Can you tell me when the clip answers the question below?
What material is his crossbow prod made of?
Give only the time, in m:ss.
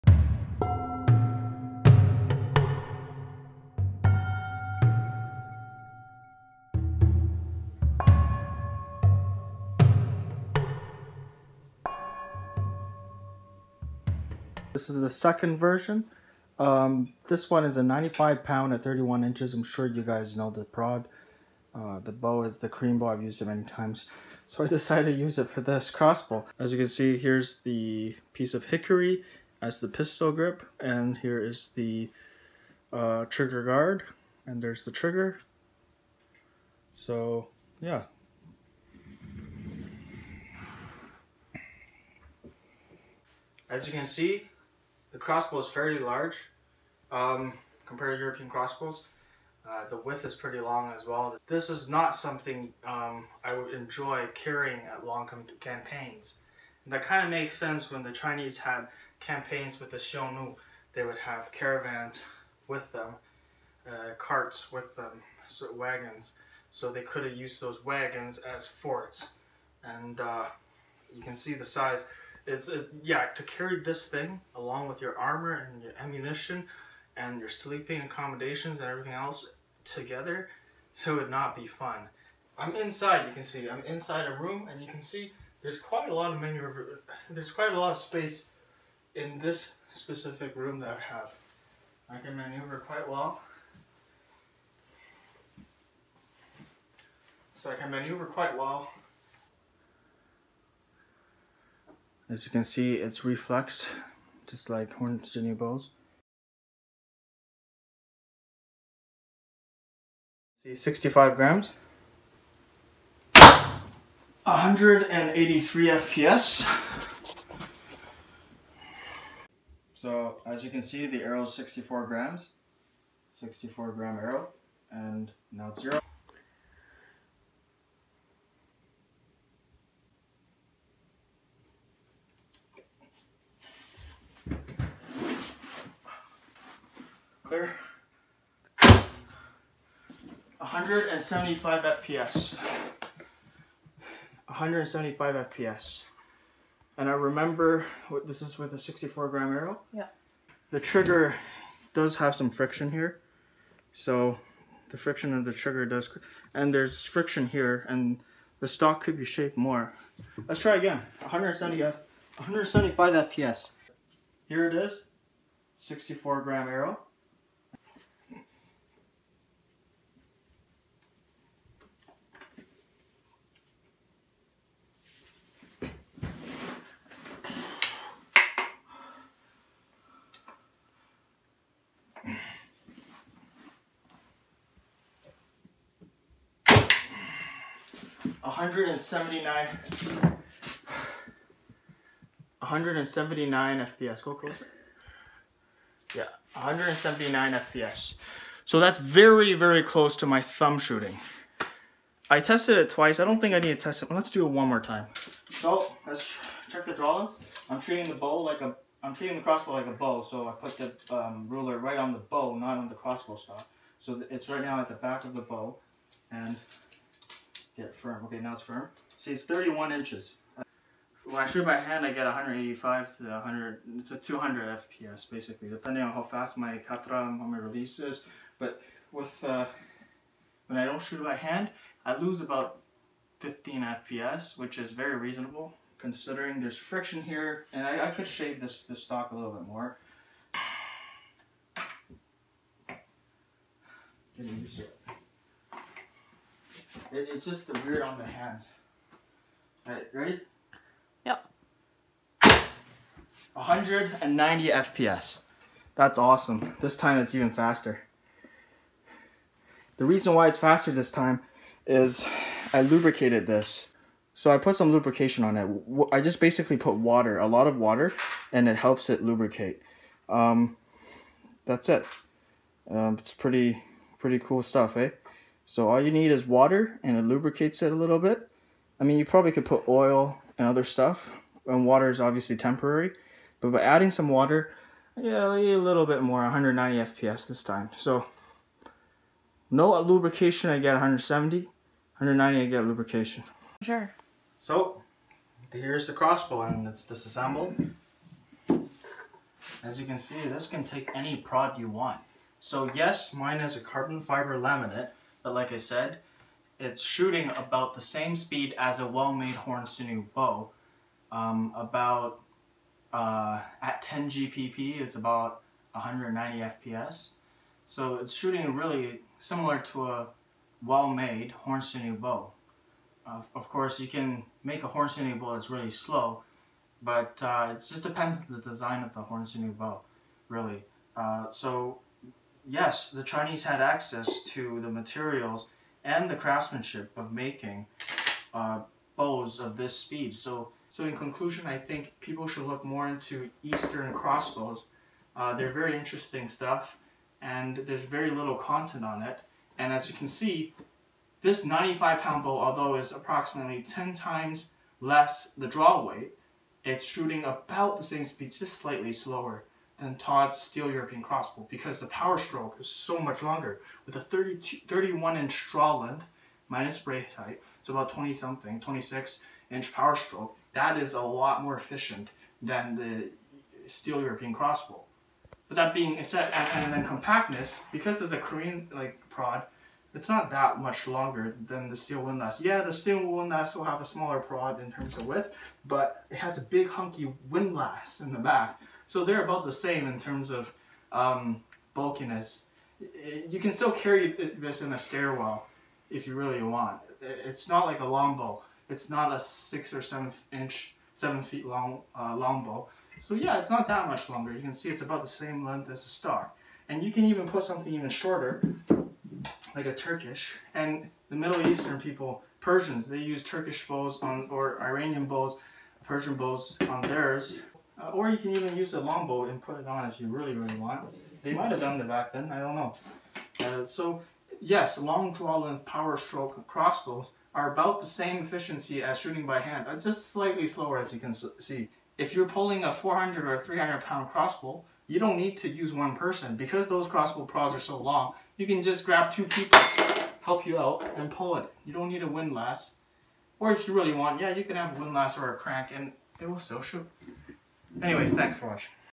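5:03.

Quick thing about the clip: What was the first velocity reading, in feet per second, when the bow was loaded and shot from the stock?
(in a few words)
183 FPS.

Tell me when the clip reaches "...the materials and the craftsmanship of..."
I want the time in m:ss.
5:34.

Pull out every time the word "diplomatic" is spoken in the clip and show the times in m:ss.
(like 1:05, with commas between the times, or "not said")
not said.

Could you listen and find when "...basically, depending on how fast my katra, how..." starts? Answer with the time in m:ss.
3:45.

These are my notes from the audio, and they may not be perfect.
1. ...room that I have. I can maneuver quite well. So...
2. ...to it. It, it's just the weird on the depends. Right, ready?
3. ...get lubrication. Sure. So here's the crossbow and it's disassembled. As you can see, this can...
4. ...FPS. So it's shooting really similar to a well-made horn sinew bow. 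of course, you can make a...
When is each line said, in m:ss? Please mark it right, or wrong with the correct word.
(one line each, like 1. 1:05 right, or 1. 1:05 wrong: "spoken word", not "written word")
1. 1:30 right
2. 4:04 wrong: "hands", not "depends"
3. 4:52 right
4. 5:16 right.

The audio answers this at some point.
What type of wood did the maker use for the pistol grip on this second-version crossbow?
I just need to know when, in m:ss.
0:28.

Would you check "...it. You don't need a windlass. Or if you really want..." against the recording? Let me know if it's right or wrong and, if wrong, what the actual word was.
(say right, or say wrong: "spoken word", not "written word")
right.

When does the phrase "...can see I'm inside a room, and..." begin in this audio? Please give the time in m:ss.
1:23.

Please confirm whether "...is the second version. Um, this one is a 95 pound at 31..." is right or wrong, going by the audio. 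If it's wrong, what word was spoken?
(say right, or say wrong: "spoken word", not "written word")
right.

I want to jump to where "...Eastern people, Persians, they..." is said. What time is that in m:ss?
6:51.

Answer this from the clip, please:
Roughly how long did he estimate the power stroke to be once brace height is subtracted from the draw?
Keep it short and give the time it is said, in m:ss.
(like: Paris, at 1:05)
26 inches, at 6:08.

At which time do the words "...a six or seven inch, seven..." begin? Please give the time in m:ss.
6:39.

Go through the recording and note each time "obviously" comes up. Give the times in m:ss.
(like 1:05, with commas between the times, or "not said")
4:42.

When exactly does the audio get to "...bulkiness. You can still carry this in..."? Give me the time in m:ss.
6:31.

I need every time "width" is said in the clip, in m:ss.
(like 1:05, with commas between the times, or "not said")
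0:49, 6:25.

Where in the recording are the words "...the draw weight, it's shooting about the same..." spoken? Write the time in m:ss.
5:55.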